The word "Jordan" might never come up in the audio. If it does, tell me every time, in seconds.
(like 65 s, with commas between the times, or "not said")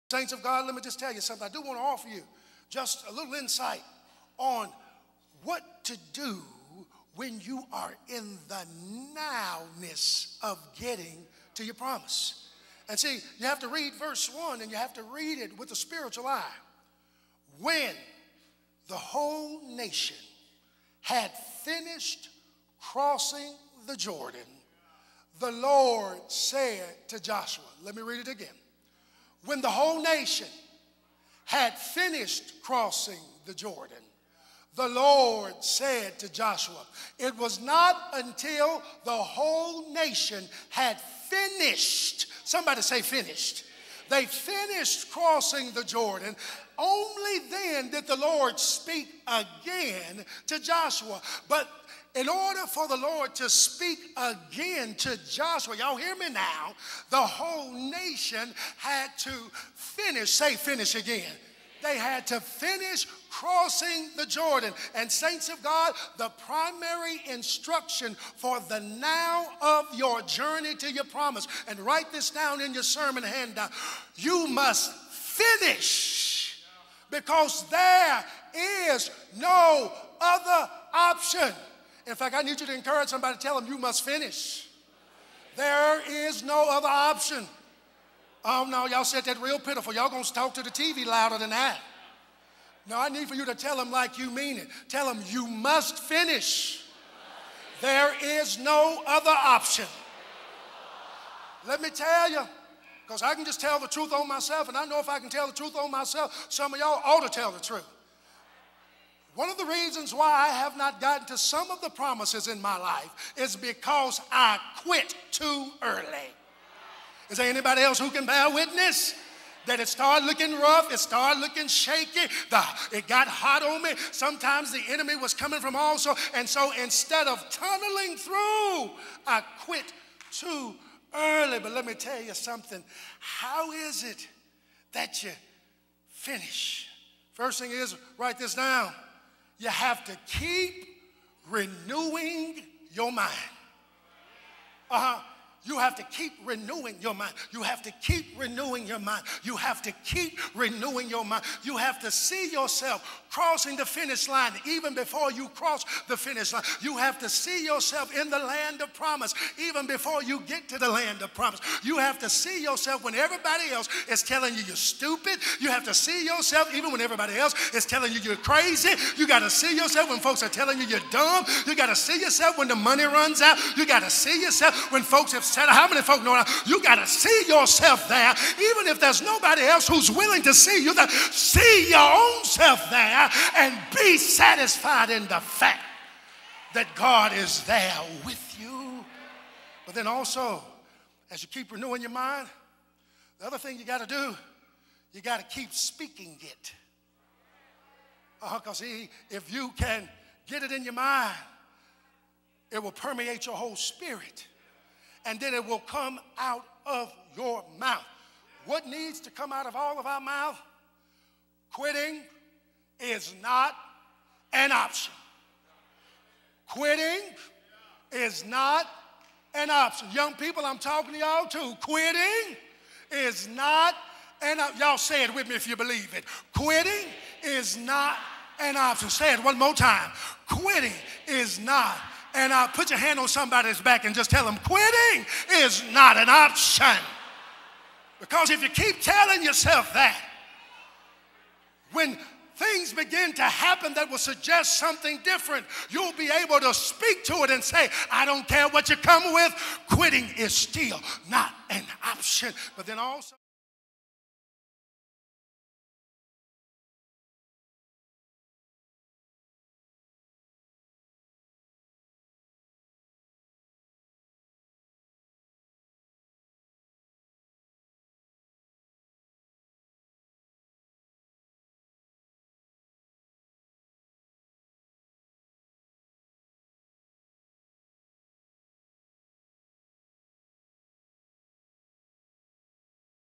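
23 s, 33 s, 45 s, 64 s.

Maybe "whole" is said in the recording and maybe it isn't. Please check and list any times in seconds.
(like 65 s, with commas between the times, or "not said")
18 s, 29 s, 39 s, 57 s, 203 s.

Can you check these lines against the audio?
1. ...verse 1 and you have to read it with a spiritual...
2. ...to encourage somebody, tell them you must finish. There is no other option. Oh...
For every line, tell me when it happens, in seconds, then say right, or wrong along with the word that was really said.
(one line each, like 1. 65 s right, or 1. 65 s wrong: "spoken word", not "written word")
1. 13 s right
2. 82 s right.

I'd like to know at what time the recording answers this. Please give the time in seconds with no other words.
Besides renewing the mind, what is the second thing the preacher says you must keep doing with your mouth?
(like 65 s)
195 s.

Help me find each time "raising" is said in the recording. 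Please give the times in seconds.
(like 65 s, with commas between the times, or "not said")
not said.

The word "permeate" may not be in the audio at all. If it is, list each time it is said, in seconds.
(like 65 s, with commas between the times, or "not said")
202 s.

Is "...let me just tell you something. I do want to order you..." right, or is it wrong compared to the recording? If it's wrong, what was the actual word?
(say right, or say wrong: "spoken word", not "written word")
wrong: "offer", not "order".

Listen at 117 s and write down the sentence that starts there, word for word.
Is there anybody else who can bear witness?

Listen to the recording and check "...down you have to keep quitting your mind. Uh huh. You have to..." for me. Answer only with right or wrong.
wrong.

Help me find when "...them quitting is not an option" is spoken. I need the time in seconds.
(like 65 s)
234 s.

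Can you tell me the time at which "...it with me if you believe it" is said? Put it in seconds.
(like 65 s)
225 s.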